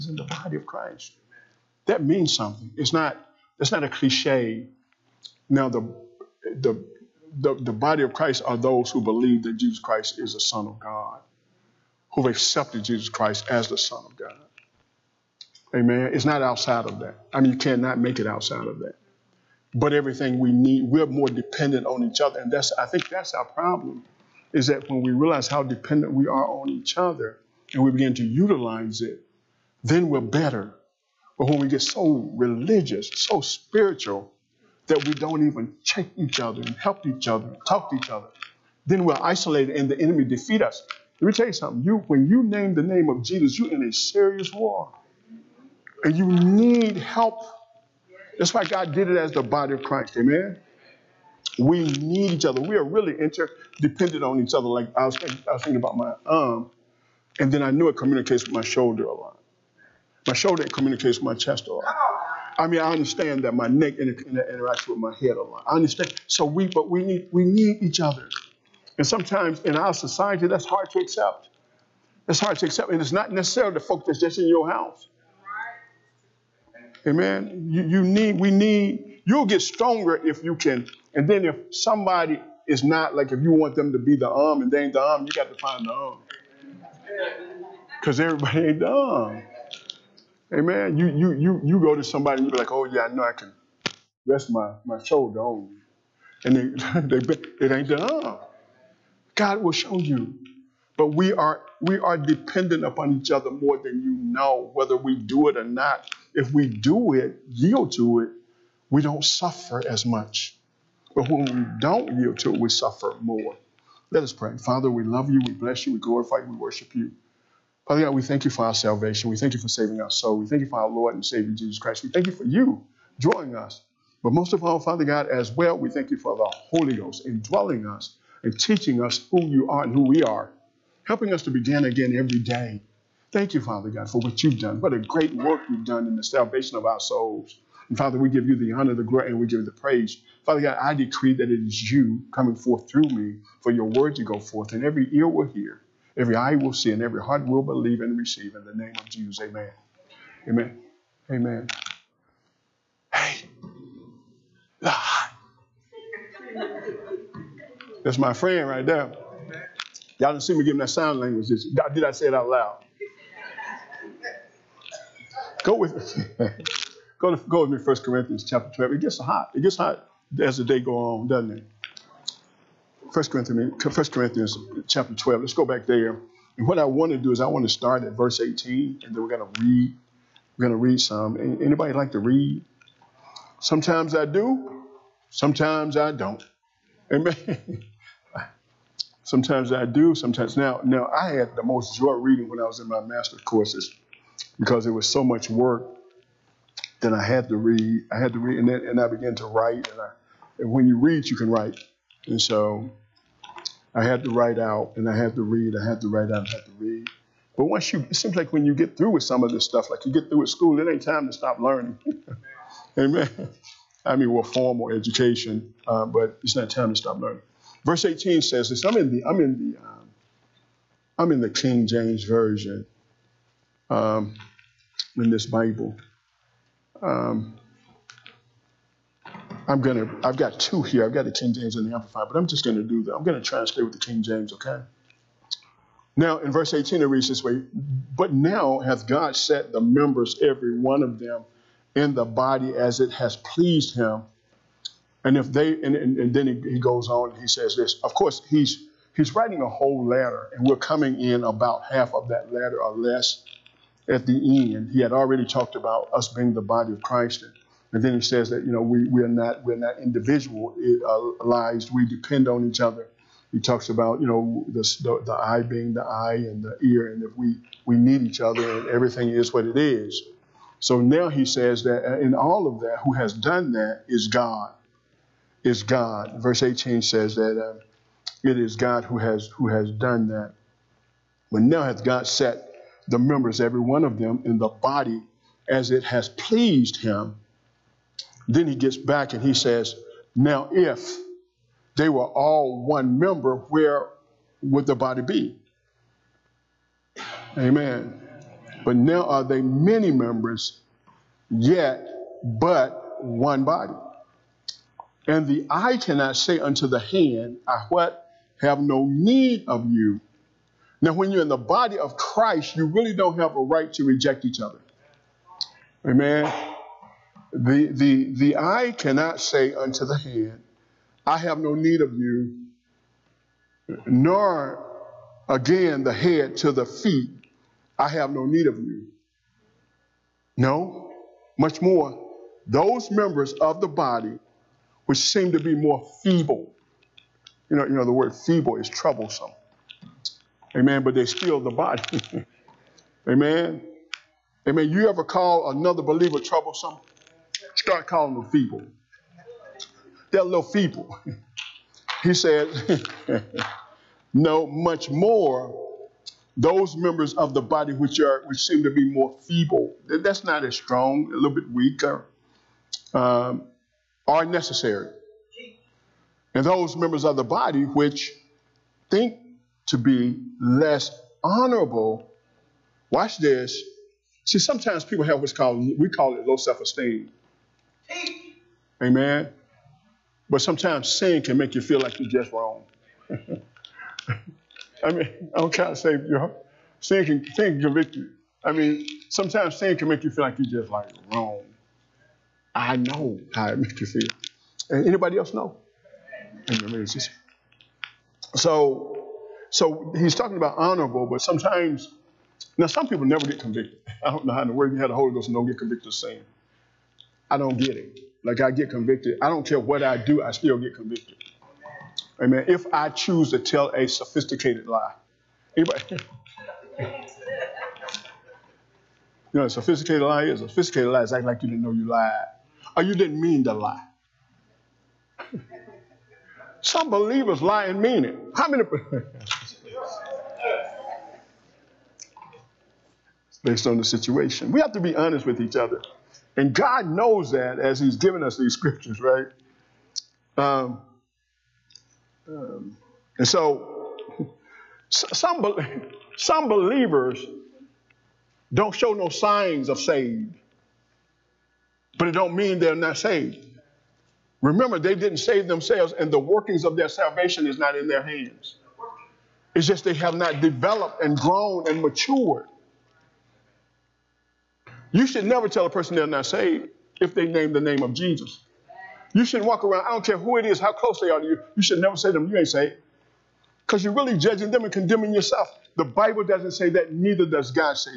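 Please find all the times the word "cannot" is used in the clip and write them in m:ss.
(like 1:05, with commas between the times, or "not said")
0:17, 5:05, 5:18.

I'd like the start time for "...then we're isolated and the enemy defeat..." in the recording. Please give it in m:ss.
0:38.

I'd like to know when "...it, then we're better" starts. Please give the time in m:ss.
0:29.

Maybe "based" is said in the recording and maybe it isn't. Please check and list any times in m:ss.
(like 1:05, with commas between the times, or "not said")
7:13.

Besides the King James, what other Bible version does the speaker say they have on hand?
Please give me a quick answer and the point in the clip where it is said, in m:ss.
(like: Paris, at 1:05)
Amplified, at 3:51.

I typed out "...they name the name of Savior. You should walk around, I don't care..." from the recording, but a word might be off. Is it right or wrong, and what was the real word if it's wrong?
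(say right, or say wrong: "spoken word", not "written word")
wrong: "Jesus", not "Savior".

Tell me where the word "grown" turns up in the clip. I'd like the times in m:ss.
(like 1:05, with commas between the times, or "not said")
7:41.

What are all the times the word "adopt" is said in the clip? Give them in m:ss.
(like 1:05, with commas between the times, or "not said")
not said.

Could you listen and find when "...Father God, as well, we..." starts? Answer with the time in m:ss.
2:04.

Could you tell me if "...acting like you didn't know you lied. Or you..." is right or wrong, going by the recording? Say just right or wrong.
right.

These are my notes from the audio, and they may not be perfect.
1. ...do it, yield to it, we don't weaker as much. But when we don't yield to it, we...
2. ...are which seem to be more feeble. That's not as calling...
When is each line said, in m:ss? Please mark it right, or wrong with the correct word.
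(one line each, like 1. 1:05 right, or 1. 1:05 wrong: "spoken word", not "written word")
1. 1:46 wrong: "suffer", not "weaker"
2. 5:58 wrong: "strong", not "calling".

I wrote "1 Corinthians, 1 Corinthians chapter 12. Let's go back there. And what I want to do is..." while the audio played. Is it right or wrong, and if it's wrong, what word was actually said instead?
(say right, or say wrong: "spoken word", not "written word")
right.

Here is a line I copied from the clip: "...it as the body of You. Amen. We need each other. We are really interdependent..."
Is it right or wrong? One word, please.
wrong.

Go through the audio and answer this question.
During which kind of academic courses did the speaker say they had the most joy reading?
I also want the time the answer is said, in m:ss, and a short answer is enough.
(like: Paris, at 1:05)
master's courses, at 3:12.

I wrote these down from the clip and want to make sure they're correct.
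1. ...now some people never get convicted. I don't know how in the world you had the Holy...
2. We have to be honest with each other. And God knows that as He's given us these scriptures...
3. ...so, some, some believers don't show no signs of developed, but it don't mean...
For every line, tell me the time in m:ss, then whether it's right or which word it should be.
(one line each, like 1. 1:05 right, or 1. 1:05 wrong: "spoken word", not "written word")
1. 6:42 right
2. 7:14 right
3. 7:23 wrong: "saved", not "developed".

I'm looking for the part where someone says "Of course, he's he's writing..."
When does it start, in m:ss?
4:08.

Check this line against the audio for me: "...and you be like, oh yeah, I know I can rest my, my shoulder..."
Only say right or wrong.
right.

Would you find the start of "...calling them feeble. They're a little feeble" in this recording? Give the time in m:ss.
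5:48.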